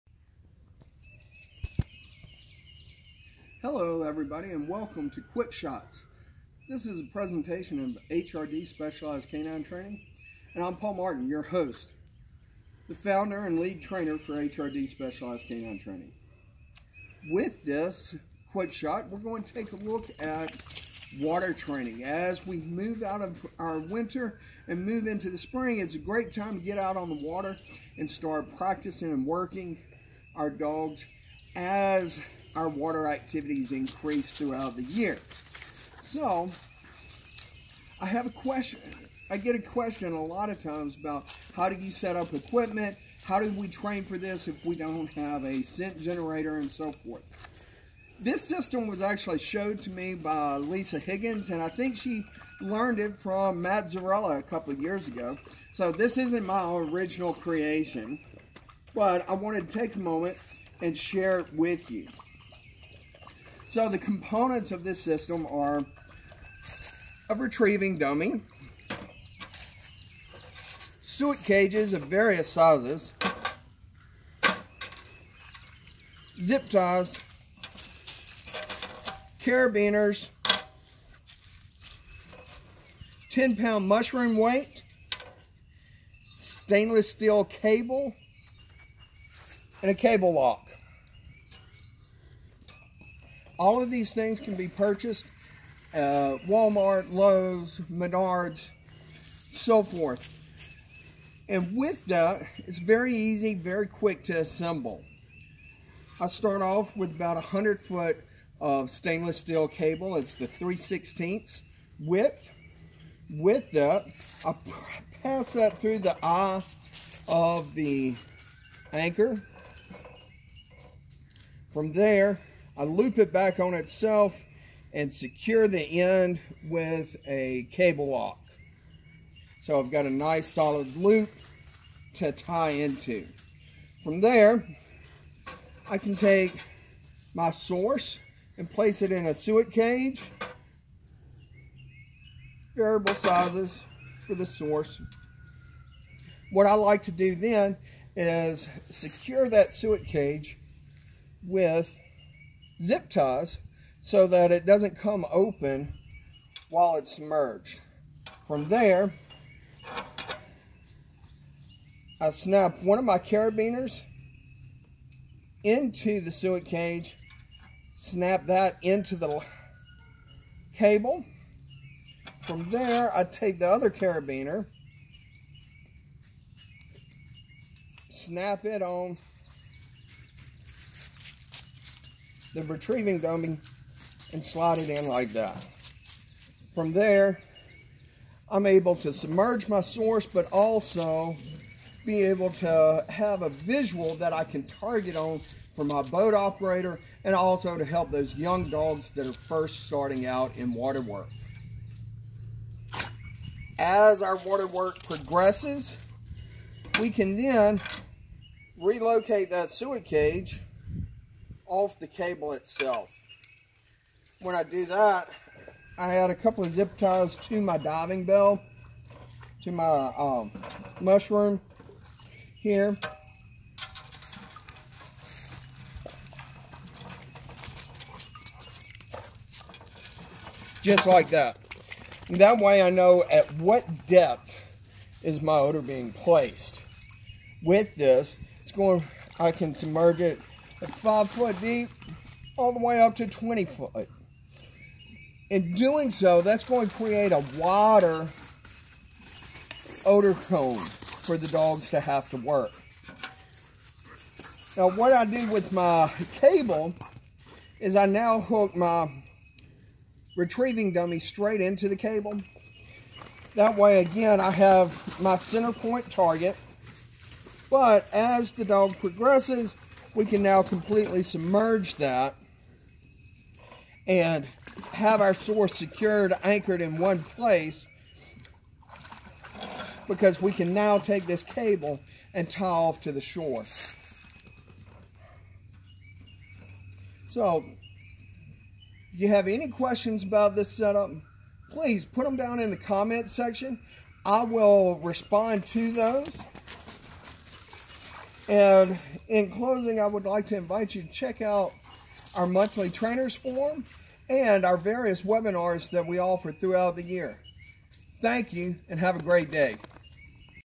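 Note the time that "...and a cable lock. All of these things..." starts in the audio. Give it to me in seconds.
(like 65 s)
89 s.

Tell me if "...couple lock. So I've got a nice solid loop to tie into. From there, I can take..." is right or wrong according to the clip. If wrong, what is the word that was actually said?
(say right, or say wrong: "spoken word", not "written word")
wrong: "cable", not "couple".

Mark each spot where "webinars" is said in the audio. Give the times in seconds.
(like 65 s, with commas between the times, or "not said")
305 s.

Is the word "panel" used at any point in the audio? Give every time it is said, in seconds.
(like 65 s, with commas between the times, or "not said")
not said.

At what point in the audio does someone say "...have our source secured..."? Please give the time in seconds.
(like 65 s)
274 s.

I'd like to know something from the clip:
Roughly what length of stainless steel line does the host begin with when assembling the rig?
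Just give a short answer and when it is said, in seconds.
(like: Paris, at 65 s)
100 feet, at 107 s.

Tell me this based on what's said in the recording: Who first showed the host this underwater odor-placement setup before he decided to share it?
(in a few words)
Lisa Higgins.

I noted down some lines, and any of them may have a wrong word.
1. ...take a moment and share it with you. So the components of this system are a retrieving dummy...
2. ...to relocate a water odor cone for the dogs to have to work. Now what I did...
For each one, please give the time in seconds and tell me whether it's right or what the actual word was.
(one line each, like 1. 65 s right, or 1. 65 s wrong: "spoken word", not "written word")
1. 59 s right
2. 246 s wrong: "create", not "relocate".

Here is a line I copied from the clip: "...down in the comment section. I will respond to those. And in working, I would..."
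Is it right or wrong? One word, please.
wrong.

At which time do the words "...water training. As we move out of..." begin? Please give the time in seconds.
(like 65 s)
21 s.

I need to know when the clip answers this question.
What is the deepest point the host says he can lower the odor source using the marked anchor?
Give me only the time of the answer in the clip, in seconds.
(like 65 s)
243 s.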